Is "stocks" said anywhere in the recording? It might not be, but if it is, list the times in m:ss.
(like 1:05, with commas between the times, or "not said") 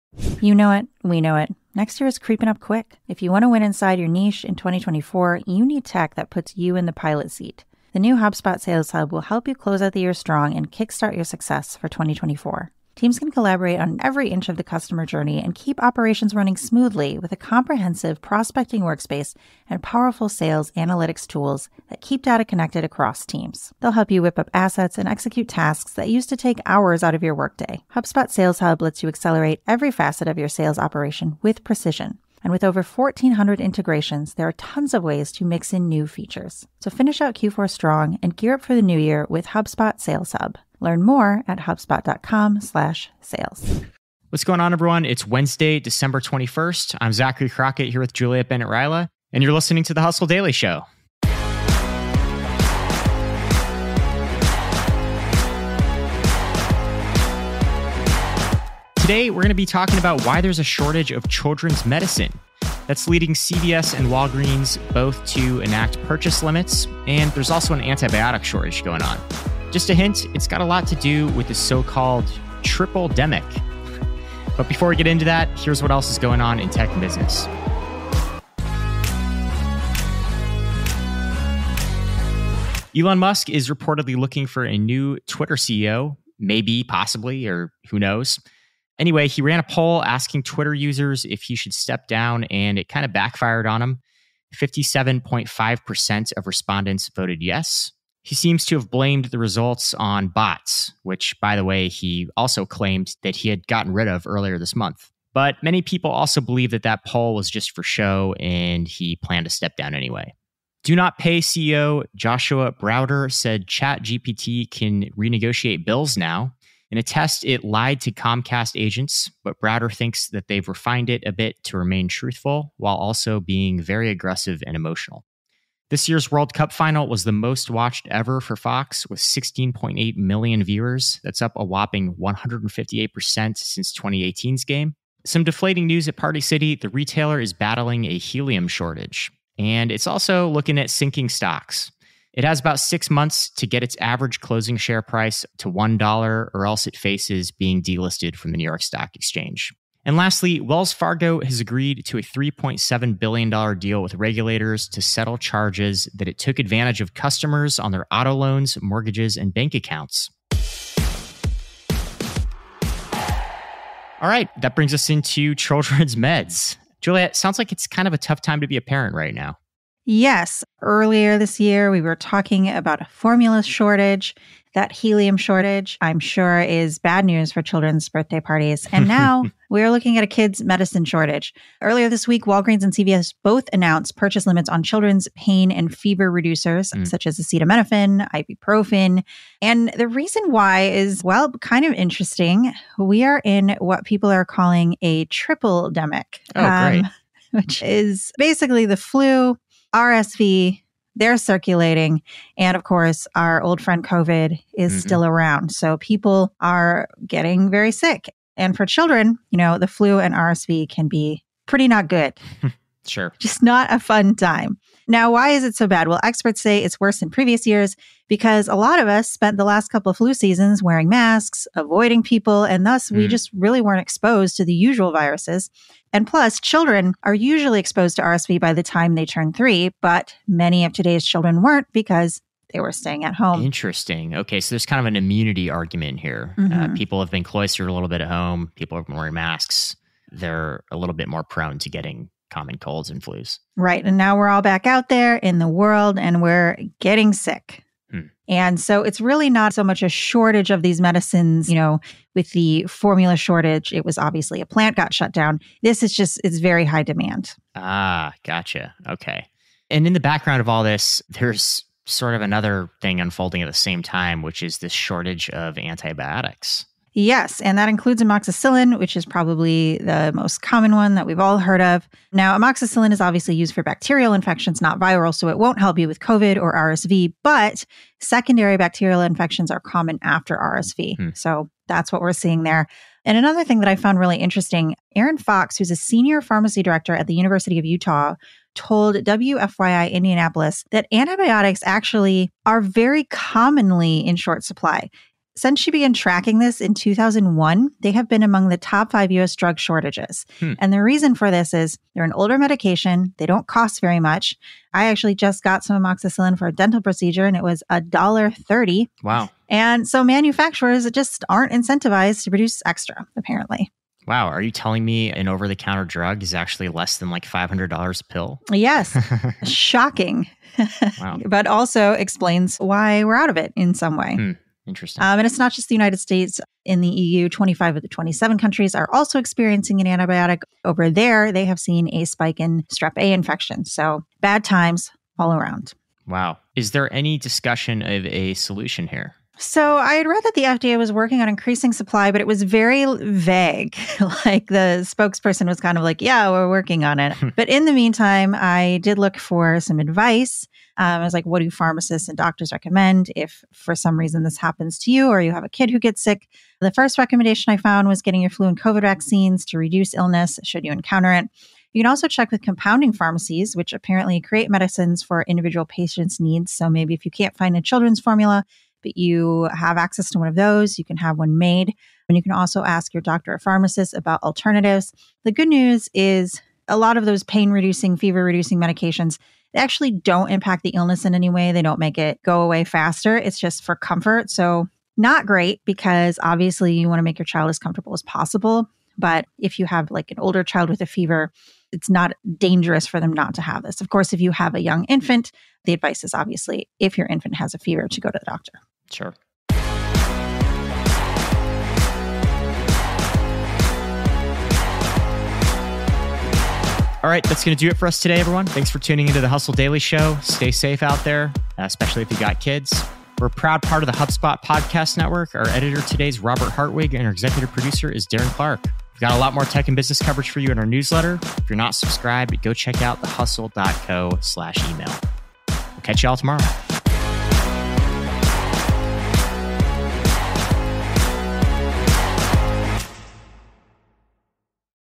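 2:21, 2:28.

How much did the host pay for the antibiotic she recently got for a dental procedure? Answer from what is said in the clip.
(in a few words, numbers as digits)
$1.30.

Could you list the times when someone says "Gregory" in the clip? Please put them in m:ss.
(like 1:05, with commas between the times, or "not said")
not said.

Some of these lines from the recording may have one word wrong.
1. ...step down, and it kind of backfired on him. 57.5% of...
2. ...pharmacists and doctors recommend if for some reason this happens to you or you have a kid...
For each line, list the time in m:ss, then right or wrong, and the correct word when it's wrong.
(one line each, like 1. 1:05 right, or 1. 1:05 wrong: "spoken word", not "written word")
1. 1:31 right
2. 5:51 right.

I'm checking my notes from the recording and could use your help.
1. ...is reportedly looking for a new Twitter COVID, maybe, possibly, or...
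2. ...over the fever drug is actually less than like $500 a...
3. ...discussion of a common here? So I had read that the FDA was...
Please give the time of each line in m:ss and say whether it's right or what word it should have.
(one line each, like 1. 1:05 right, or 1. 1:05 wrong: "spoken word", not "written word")
1. 1:23 wrong: "CEO", not "COVID"
2. 5:15 wrong: "counter", not "fever"
3. 5:37 wrong: "solution", not "common".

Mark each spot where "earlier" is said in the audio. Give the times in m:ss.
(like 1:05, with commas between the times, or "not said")
1:44, 2:50, 3:01.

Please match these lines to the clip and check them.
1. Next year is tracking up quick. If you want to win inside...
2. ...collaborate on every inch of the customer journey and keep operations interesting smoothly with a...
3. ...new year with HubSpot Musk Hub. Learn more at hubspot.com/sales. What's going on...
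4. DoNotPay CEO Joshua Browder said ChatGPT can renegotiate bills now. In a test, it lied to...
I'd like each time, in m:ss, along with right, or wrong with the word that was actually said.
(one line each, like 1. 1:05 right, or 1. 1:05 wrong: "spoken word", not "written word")
1. 0:01 wrong: "creeping", not "tracking"
2. 0:13 wrong: "running", not "interesting"
3. 0:38 wrong: "Sales", not "Musk"
4. 1:50 right.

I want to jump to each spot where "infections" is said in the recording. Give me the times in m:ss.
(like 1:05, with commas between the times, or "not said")
4:34, 4:39, 5:33.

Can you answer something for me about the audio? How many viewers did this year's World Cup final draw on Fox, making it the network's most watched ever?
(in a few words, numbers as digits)
16.8 million.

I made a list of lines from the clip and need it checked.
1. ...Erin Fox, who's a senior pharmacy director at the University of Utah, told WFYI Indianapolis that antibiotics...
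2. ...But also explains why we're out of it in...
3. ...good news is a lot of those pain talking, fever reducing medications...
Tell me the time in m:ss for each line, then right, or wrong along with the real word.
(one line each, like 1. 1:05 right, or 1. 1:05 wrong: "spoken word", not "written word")
1. 4:45 right
2. 5:21 right
3. 6:15 wrong: "reducing", not "talking".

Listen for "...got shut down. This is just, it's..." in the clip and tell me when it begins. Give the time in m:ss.
4:14.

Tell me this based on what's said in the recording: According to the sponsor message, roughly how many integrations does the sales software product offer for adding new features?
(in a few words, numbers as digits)
1,400.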